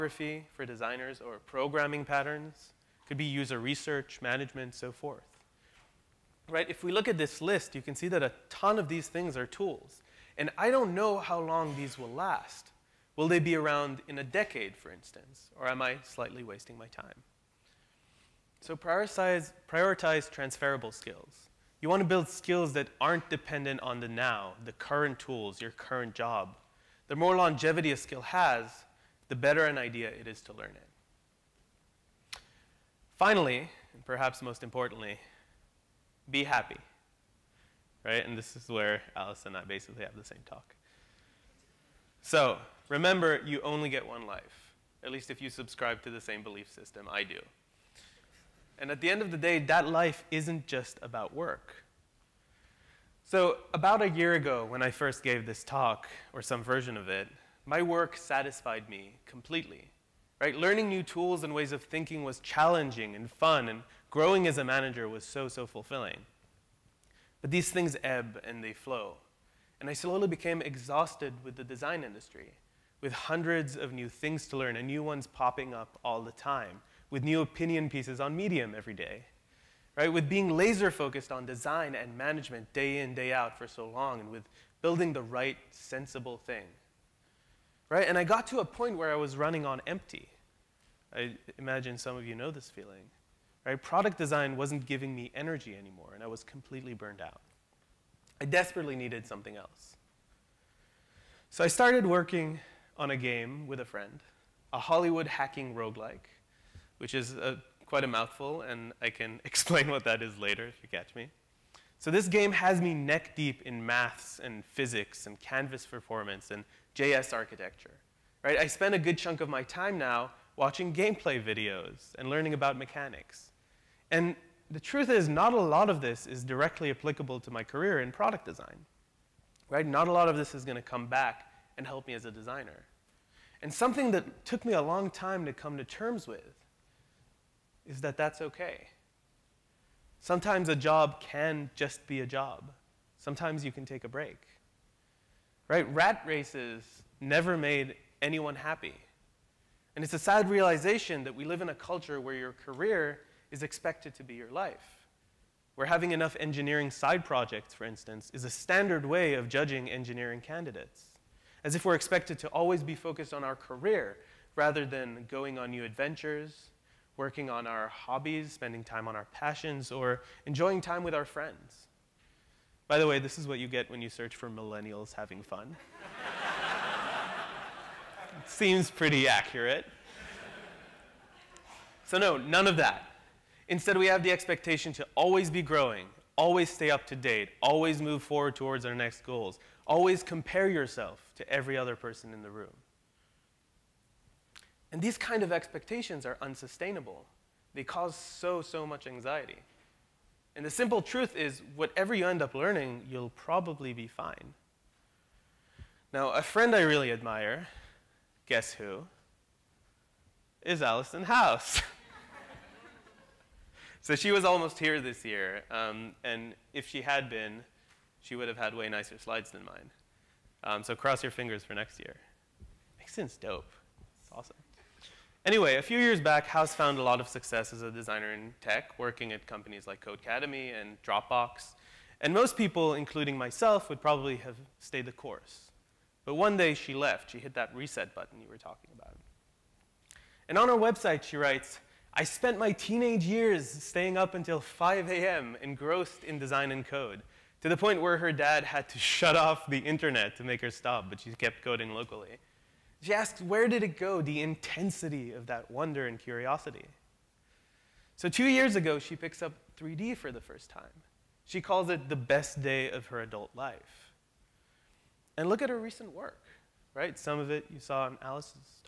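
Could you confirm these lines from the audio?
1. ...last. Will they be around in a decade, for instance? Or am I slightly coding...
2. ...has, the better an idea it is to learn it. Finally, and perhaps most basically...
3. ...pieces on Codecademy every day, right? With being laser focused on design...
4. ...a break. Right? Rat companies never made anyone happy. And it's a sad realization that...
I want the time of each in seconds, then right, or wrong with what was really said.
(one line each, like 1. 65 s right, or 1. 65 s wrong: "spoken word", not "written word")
1. 12 s wrong: "wasting", not "coding"
2. 28 s wrong: "importantly", not "basically"
3. 77 s wrong: "Medium", not "Codecademy"
4. 144 s wrong: "races", not "companies".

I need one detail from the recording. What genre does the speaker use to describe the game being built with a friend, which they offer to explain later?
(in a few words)
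Hollywood hacking roguelike.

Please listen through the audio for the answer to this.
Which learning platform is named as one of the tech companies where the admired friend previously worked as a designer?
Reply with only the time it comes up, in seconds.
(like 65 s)
230 s.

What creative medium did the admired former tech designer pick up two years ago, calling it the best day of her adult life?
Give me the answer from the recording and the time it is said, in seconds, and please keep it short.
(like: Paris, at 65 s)
3D, at 259 s.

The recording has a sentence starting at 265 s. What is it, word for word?
And look at her recent work, right?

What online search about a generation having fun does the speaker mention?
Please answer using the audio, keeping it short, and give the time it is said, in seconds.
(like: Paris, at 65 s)
millennials having fun, at 174 s.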